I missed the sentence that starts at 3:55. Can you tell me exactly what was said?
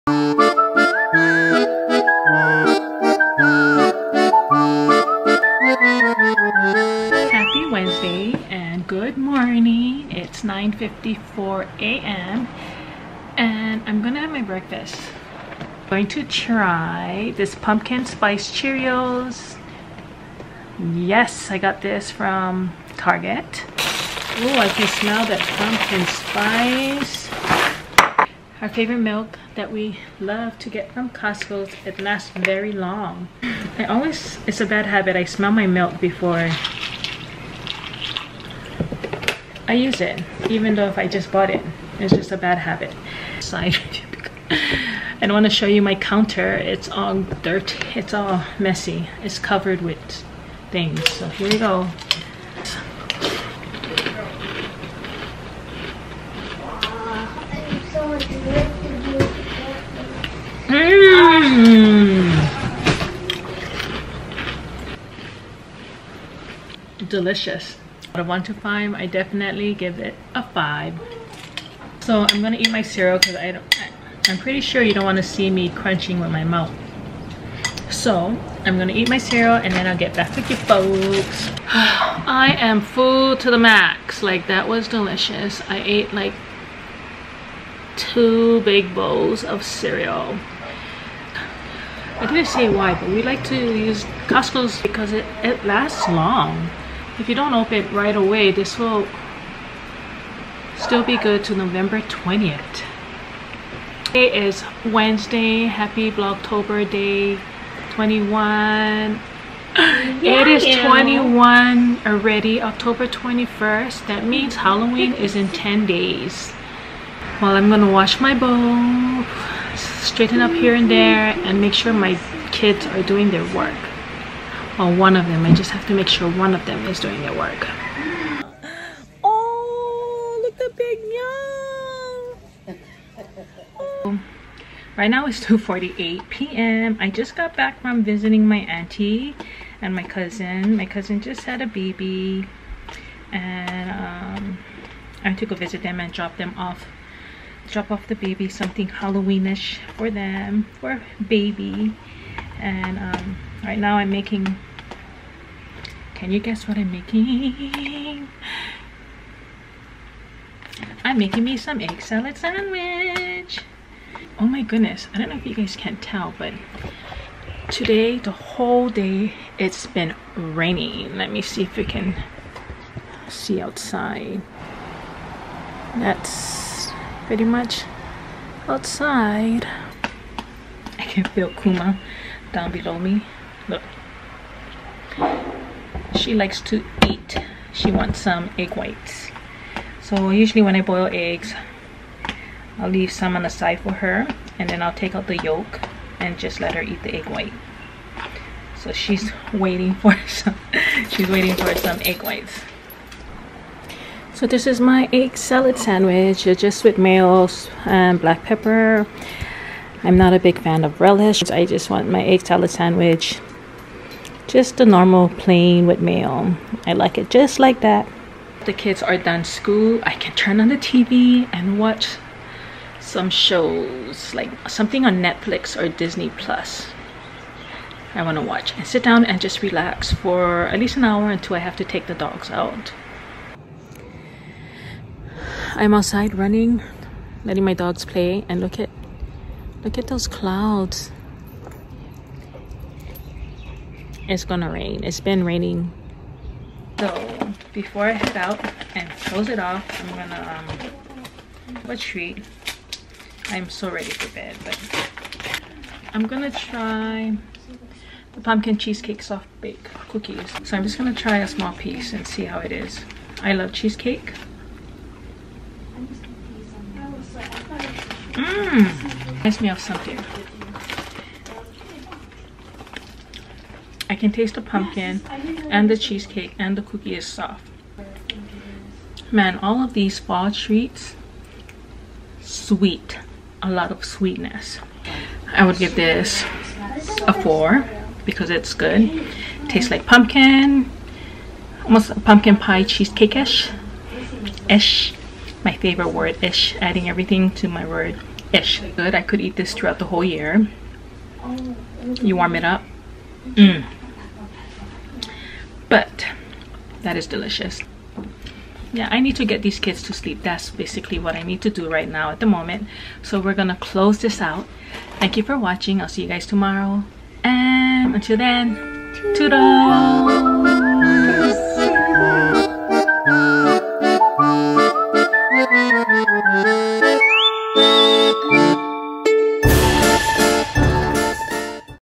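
I'm outside running, letting my dogs play and look at look at those clouds.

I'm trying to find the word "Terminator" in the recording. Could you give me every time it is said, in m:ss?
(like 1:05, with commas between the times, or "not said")
not said.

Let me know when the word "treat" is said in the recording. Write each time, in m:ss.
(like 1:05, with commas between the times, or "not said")
4:11, 4:40.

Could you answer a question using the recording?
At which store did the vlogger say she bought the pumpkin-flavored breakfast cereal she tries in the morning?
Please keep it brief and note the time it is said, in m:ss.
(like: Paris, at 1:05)
Target, at 0:22.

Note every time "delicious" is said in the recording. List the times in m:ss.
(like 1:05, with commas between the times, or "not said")
1:07, 1:24, 5:07.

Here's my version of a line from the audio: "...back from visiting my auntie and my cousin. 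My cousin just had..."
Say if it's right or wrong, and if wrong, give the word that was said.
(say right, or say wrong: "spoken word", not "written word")
right.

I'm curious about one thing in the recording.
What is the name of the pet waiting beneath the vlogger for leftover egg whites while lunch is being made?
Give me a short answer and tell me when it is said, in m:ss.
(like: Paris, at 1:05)
Kuma, at 3:01.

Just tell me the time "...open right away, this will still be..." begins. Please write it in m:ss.
1:37.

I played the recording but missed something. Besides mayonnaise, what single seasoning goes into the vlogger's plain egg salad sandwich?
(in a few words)
Black pepper.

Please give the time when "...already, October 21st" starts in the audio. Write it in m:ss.
1:52.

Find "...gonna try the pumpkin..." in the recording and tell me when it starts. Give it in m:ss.
4:16.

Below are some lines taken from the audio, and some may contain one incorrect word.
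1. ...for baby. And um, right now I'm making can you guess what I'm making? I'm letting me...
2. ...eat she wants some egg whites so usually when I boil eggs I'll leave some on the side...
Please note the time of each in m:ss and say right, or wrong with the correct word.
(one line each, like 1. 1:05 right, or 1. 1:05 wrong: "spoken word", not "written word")
1. 2:30 wrong: "making", not "letting"
2. 3:07 right.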